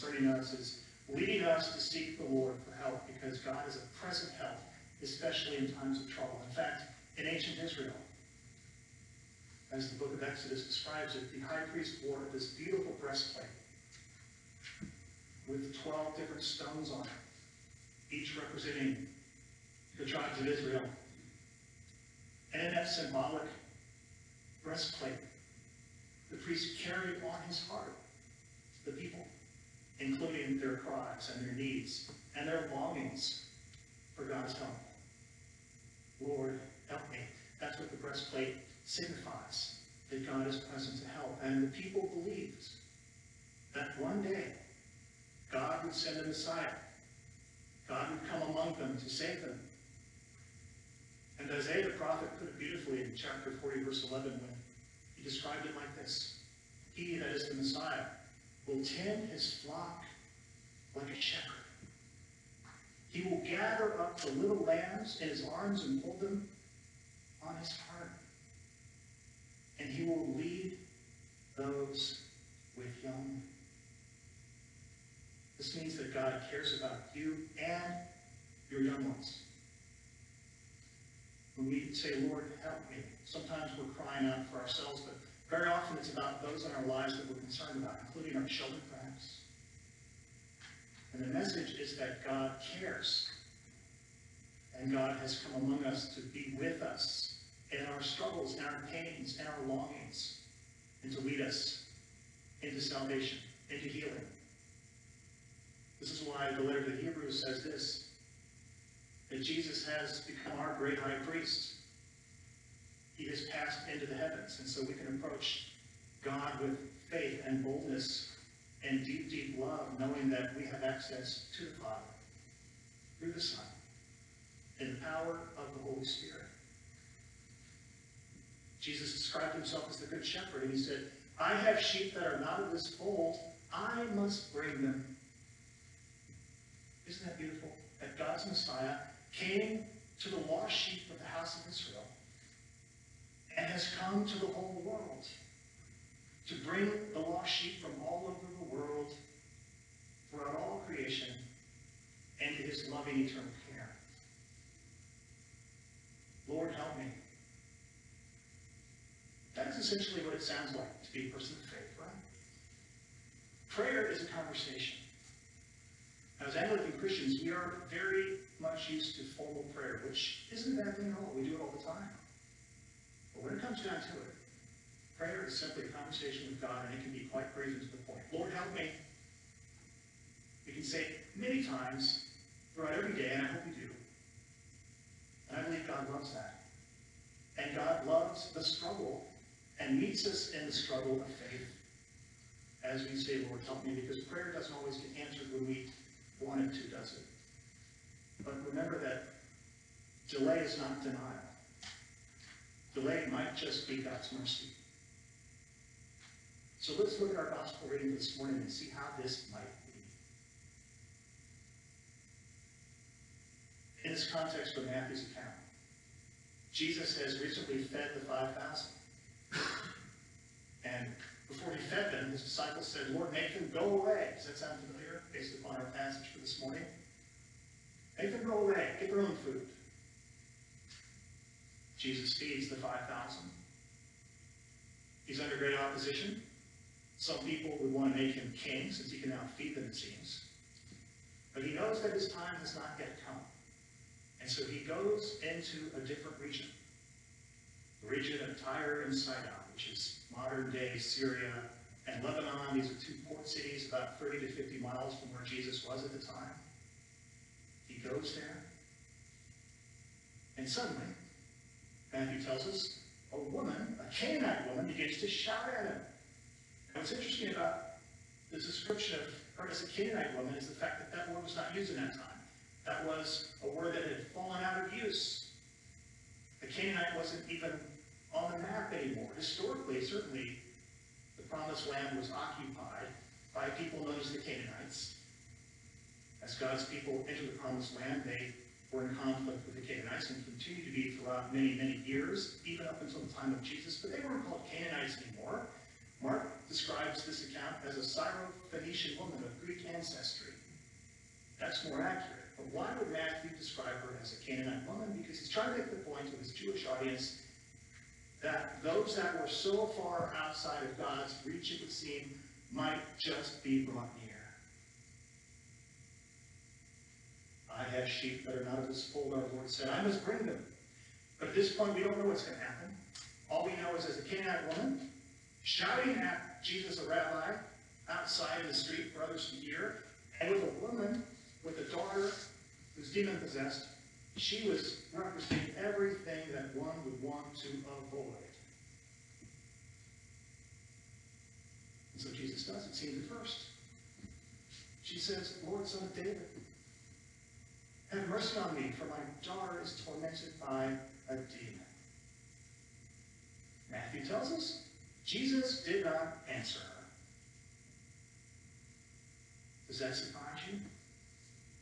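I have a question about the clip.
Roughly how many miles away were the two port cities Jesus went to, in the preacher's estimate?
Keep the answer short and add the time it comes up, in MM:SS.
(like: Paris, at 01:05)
30 to 50 miles, at 04:14.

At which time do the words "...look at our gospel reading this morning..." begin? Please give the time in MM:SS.
03:27.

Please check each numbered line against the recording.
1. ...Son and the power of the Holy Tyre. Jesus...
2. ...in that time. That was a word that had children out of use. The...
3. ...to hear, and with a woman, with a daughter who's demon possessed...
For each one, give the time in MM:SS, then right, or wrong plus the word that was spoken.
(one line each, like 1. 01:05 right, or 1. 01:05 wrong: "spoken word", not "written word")
1. 02:03 wrong: "Spirit", not "Tyre"
2. 04:31 wrong: "fallen", not "children"
3. 05:29 right.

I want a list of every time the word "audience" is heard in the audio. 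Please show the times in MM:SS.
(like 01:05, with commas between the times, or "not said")
05:06.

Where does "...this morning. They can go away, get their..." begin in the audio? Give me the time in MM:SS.
03:46.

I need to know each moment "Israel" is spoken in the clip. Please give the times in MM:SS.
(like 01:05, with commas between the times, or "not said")
00:07, 00:20, 02:21.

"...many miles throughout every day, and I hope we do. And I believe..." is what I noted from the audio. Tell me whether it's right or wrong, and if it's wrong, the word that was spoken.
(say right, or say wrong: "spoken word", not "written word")
wrong: "times", not "miles".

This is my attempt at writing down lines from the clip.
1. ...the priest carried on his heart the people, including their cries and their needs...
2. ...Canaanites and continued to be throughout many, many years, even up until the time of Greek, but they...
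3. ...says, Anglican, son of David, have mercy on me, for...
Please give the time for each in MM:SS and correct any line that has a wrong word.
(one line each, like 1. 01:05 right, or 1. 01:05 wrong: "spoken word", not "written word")
1. 00:26 right
2. 04:49 wrong: "Jesus", not "Greek"
3. 05:45 wrong: "Lord", not "Anglican".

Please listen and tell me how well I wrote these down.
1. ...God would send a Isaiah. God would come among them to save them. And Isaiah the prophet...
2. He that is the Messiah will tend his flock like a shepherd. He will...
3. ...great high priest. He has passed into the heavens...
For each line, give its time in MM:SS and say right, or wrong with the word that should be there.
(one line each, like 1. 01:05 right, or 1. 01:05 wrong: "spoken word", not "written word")
1. 00:45 wrong: "Messiah", not "Isaiah"
2. 00:56 right
3. 01:50 right.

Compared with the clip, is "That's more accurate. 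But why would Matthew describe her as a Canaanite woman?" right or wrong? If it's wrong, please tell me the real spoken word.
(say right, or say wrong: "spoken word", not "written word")
right.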